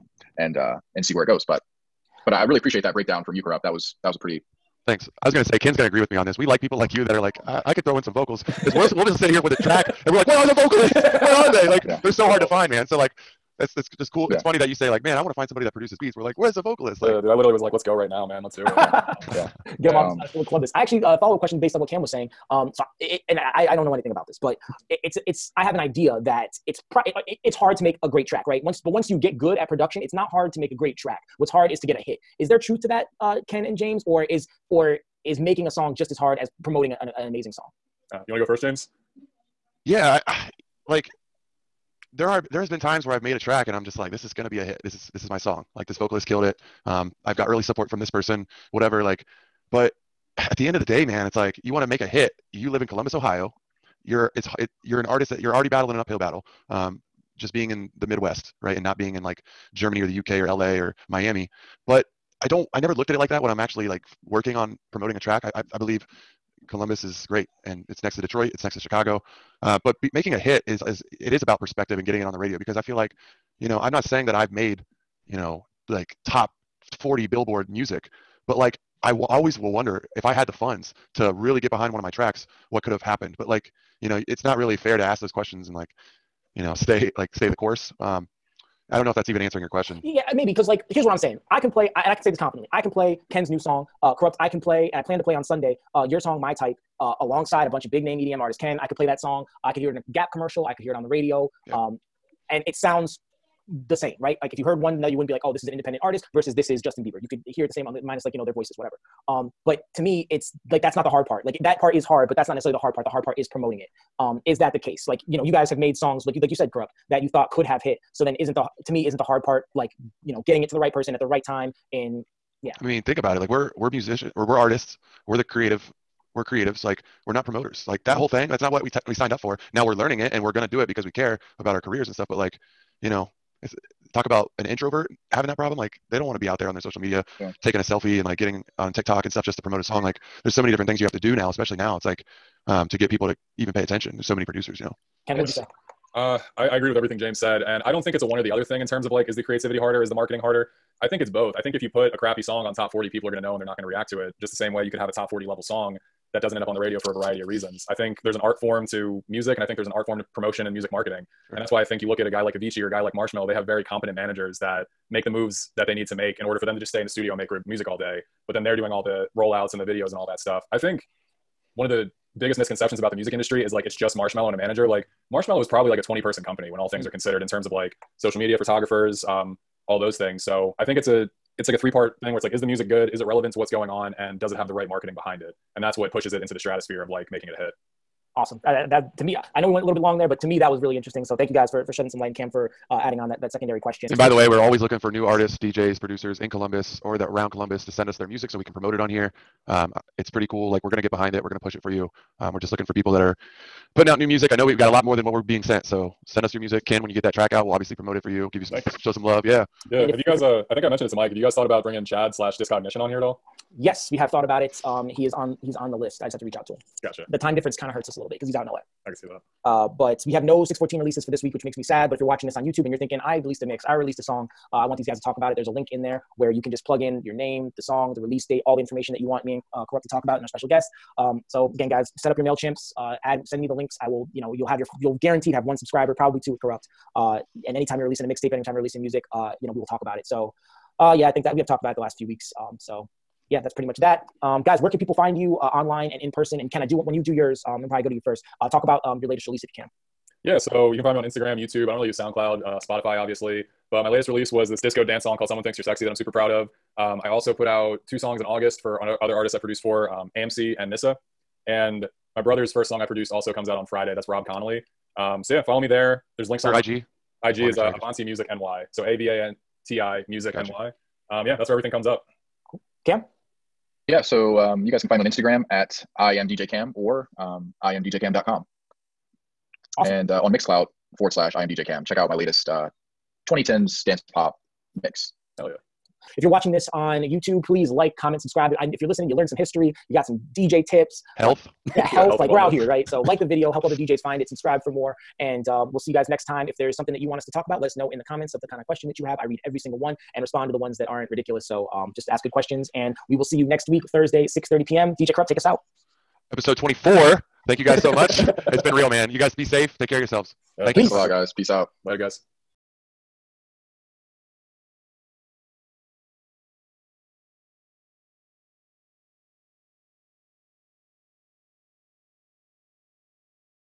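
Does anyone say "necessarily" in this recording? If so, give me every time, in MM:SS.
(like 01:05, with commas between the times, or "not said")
01:52.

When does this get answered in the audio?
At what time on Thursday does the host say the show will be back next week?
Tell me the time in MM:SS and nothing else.
05:04.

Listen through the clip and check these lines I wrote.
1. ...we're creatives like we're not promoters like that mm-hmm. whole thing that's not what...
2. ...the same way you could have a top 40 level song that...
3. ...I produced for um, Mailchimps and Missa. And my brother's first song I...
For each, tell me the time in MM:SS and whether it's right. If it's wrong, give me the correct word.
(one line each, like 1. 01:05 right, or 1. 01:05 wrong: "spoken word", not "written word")
1. 02:06 right
2. 02:34 right
3. 04:19 wrong: "AMC", not "Mailchimps".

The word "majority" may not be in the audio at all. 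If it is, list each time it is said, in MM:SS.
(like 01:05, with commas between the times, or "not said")
not said.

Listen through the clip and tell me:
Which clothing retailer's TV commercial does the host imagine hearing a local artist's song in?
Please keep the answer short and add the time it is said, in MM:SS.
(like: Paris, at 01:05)
Gap, at 01:40.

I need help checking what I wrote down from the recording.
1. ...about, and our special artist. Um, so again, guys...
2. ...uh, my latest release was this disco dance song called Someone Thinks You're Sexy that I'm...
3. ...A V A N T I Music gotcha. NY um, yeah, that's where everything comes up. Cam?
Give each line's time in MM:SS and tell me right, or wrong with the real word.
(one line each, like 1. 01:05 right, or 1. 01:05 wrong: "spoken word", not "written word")
1. 03:50 wrong: "guest", not "artist"
2. 04:13 right
3. 04:29 right.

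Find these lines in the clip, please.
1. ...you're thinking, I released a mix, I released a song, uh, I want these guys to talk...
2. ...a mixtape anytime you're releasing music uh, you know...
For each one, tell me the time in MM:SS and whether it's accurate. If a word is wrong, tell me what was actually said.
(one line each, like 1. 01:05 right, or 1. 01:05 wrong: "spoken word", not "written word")
1. 03:42 right
2. 03:58 right.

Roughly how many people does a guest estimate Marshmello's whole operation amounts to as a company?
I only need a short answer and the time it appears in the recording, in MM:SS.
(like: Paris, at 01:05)
20, at 02:56.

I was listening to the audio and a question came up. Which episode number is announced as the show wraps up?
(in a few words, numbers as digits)
24.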